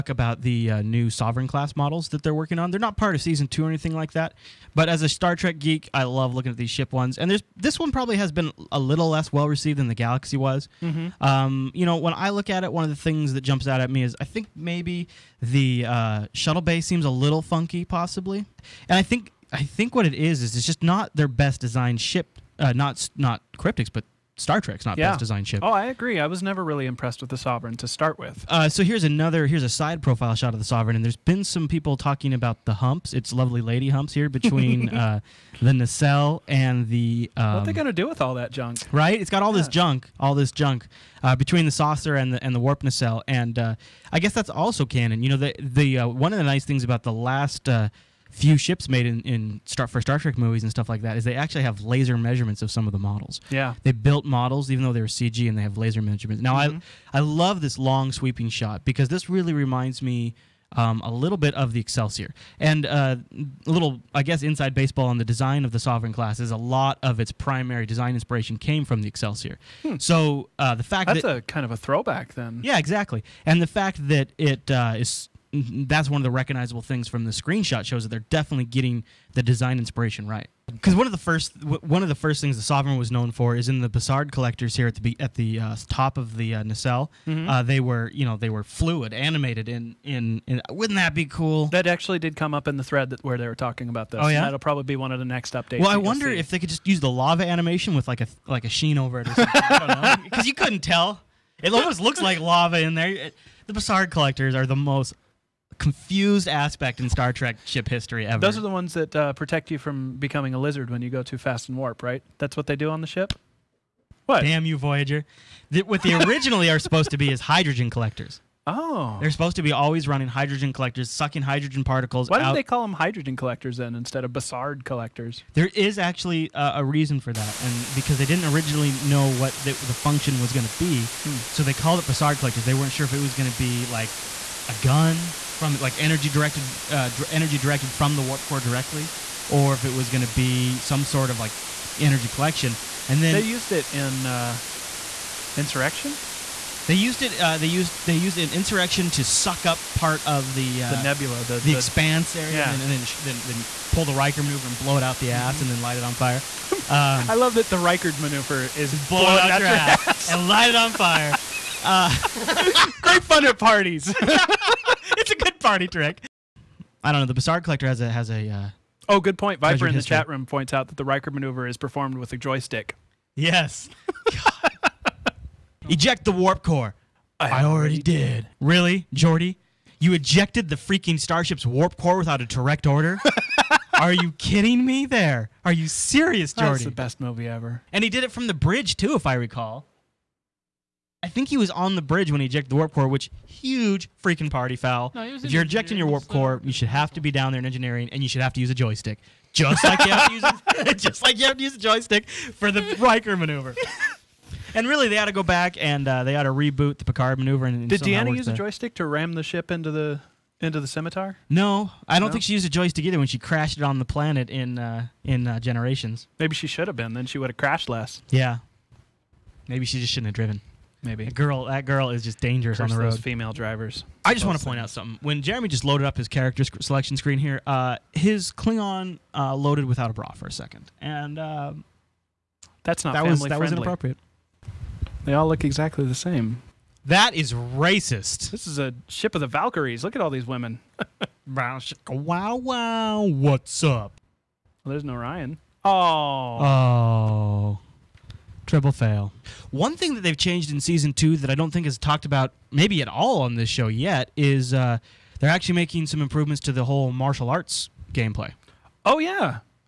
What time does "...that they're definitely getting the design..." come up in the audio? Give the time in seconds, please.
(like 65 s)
78 s.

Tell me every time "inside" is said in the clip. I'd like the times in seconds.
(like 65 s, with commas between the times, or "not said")
64 s.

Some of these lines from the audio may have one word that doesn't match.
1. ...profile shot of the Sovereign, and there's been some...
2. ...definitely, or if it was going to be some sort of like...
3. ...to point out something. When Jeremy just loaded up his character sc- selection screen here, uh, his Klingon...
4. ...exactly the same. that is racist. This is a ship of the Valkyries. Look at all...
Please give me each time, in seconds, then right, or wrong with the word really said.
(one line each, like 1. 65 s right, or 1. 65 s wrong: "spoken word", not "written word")
1. 30 s right
2. 138 s wrong: "directly", not "definitely"
3. 224 s right
4. 235 s right.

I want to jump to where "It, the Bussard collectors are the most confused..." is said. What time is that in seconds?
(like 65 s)
103 s.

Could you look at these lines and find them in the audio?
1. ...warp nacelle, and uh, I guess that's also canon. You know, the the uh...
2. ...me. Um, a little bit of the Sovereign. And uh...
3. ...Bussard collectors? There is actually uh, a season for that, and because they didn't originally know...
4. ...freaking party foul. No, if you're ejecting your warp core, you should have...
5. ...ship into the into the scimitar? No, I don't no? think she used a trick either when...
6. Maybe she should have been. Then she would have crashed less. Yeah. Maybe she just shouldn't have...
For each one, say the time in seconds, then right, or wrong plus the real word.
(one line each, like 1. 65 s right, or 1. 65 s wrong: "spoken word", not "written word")
1. 42 s right
2. 60 s wrong: "Excelsior", not "Sovereign"
3. 124 s wrong: "reason", not "season"
4. 194 s right
5. 209 s wrong: "joystick", not "trick"
6. 216 s right.